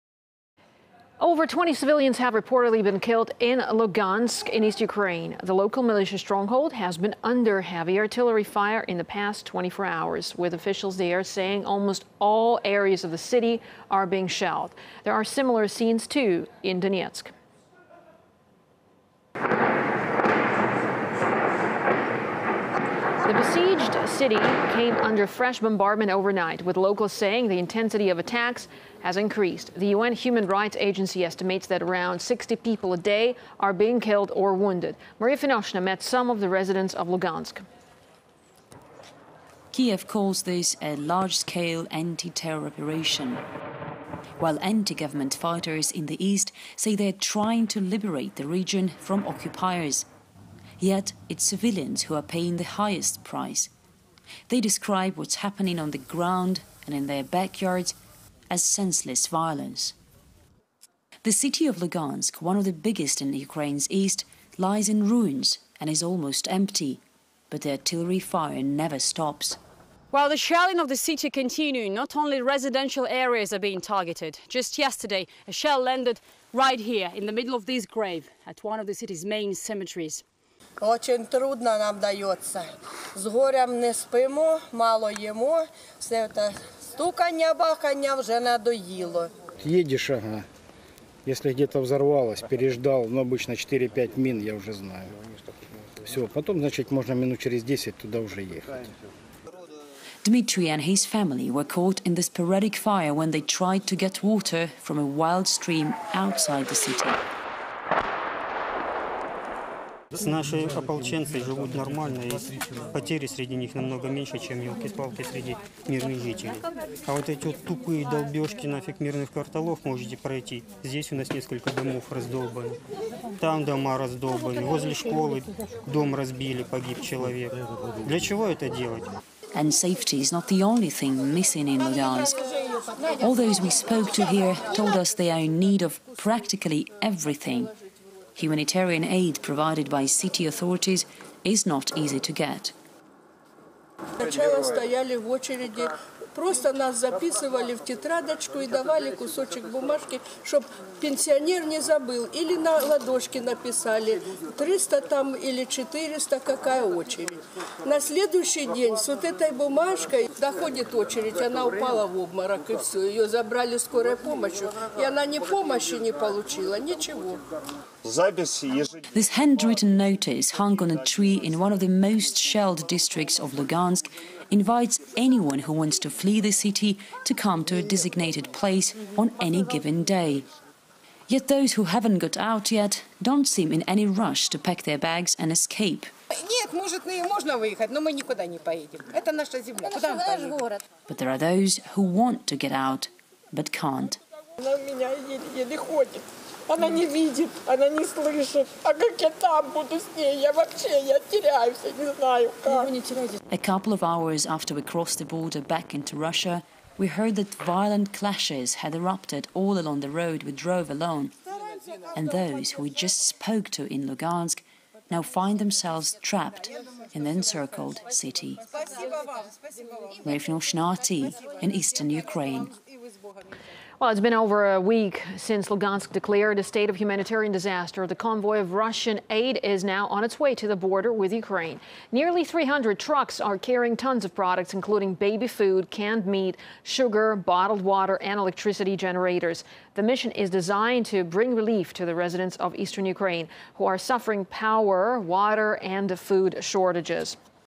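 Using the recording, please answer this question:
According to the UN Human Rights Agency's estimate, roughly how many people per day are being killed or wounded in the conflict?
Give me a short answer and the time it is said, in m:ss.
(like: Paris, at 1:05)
60, at 0:32.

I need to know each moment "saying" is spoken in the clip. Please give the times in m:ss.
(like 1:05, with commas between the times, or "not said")
0:11, 0:27.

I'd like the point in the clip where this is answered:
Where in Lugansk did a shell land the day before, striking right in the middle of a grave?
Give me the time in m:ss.
1:18.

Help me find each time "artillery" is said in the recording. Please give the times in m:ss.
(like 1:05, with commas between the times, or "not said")
0:07, 1:07.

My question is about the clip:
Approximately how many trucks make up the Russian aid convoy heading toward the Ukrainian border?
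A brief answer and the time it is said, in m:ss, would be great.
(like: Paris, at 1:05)
nearly 300, at 3:52.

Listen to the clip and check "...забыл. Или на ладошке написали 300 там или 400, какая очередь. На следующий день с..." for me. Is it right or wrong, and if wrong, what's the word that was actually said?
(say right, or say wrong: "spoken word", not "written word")
right.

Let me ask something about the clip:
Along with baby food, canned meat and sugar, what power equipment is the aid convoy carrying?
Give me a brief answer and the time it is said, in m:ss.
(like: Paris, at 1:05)
electricity generators, at 3:58.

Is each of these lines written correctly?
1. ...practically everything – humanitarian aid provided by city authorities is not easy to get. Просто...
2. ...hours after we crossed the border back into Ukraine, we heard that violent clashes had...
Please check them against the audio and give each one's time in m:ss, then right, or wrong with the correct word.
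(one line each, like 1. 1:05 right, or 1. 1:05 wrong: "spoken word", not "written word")
1. 2:16 right
2. 3:24 wrong: "Russia", not "Ukraine".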